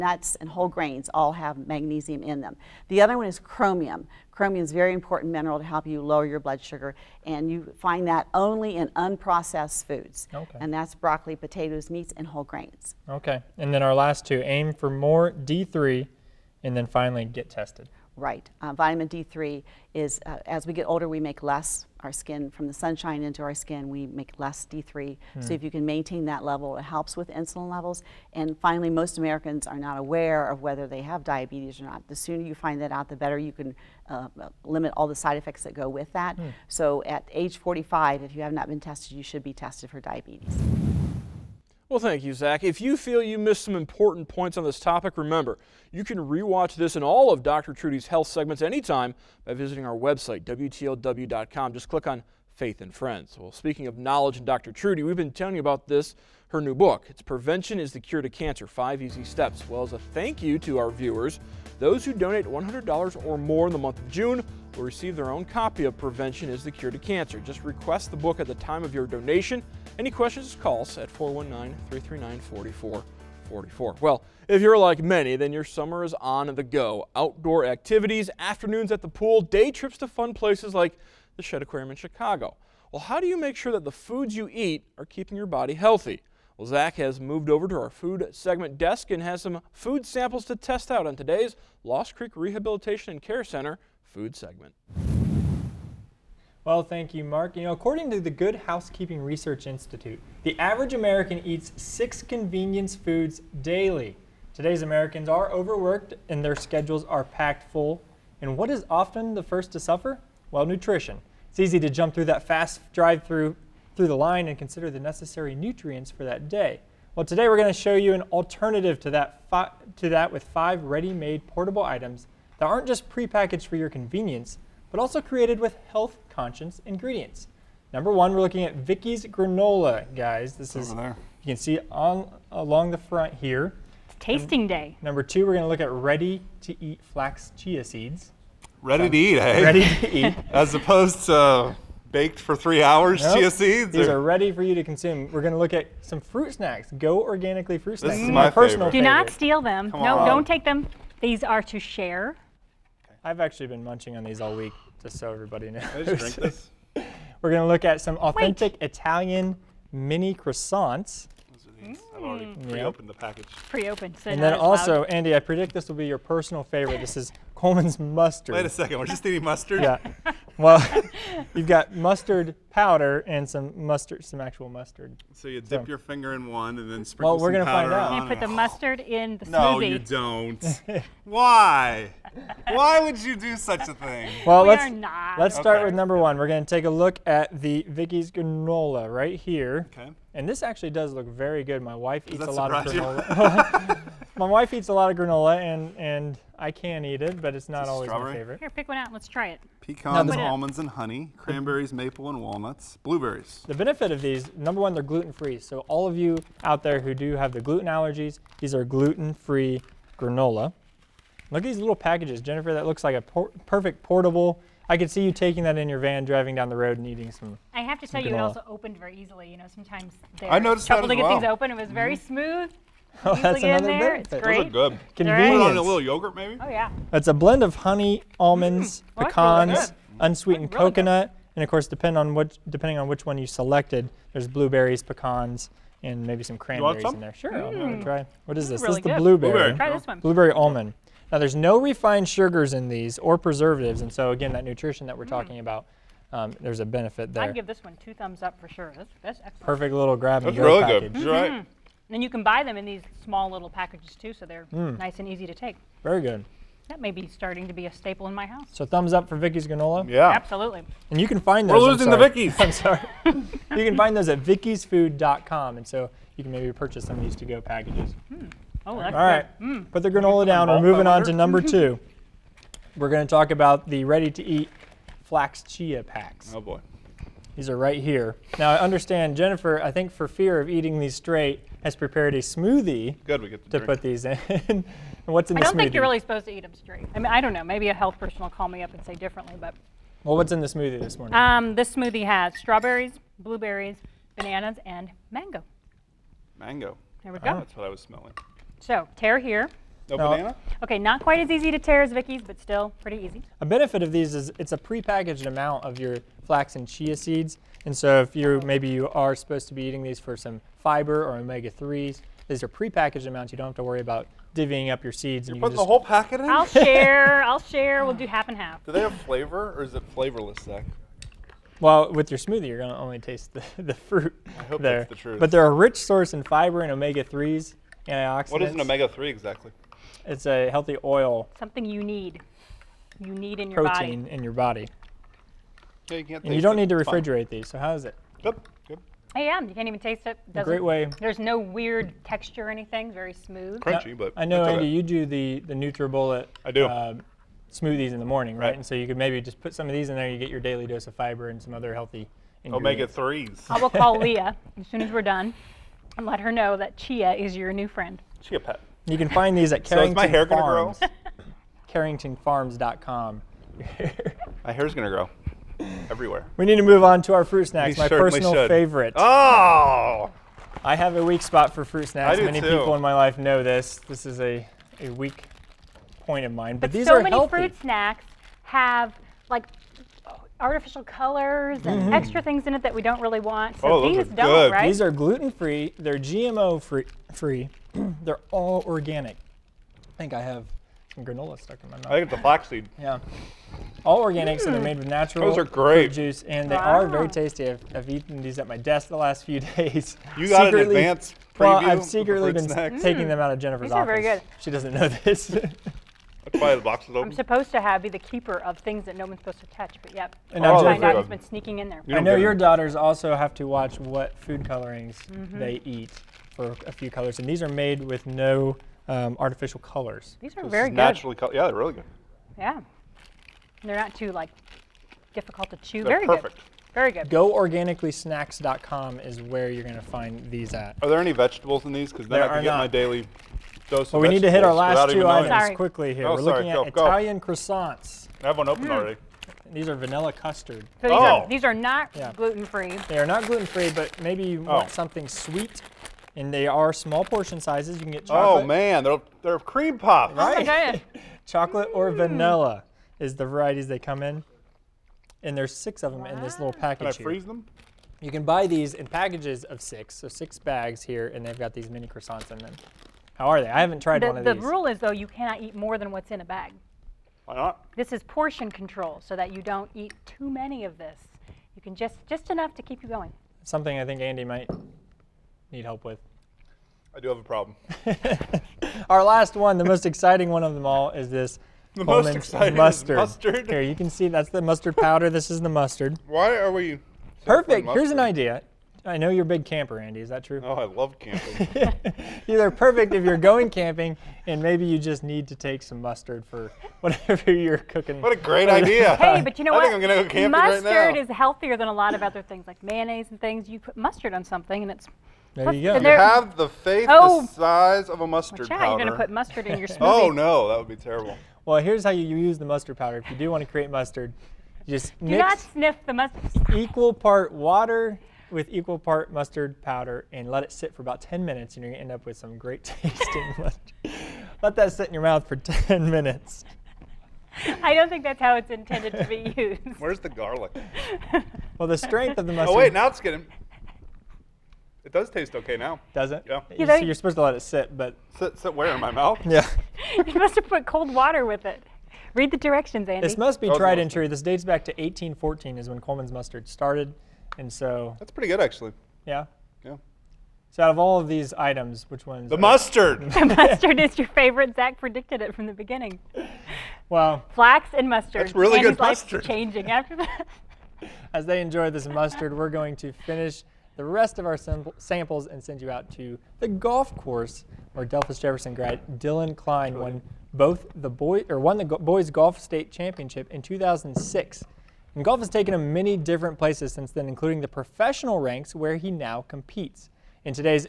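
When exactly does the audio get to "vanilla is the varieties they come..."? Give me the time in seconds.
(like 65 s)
452 s.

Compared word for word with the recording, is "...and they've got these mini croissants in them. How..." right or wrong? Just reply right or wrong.
right.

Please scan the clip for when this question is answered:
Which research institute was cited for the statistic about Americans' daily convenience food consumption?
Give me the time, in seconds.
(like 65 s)
98 s.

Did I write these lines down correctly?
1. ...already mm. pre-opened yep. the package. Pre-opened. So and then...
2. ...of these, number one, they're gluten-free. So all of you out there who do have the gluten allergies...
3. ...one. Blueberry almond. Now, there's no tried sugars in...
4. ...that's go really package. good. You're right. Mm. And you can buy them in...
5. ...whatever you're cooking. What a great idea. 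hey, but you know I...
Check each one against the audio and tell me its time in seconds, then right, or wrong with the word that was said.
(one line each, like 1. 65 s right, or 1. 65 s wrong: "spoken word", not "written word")
1. 162 s right
2. 204 s right
3. 240 s wrong: "refined", not "tried"
4. 250 s right
5. 497 s right.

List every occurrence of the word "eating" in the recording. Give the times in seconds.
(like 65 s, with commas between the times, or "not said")
169 s, 217 s, 280 s, 309 s.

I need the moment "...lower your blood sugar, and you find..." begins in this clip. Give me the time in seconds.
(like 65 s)
6 s.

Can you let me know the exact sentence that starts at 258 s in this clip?
So thumbs up for Vicky's granola.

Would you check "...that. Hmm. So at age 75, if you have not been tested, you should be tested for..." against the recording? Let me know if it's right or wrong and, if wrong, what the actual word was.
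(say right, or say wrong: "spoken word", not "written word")
wrong: "45", not "75".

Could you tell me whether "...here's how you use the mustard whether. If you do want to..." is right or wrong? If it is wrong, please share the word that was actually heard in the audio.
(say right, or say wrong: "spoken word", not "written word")
wrong: "powder", not "whether".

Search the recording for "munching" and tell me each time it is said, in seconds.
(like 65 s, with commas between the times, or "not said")
153 s.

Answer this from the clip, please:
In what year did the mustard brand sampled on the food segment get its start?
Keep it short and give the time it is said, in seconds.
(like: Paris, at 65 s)
1814, at 544 s.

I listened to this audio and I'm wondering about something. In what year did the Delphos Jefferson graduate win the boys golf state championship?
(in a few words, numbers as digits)
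2006.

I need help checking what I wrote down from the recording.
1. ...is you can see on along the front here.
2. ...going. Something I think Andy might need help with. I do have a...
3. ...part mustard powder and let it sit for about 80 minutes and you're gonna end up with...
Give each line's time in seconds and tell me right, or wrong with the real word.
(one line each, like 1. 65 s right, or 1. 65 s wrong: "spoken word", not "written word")
1. 130 s right
2. 473 s right
3. 518 s wrong: "10", not "80".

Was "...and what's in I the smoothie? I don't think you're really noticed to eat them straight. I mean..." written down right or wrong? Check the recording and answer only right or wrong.
wrong.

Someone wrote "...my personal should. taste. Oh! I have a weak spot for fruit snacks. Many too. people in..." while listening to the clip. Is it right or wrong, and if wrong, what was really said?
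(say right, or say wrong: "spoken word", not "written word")
wrong: "favorite", not "taste".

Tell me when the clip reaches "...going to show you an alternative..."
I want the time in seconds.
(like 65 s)
117 s.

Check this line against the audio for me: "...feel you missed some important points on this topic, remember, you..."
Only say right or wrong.
right.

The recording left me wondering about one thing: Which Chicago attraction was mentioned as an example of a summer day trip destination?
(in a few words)
Shedd Aquarium.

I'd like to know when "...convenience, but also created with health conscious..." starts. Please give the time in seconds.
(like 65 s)
123 s.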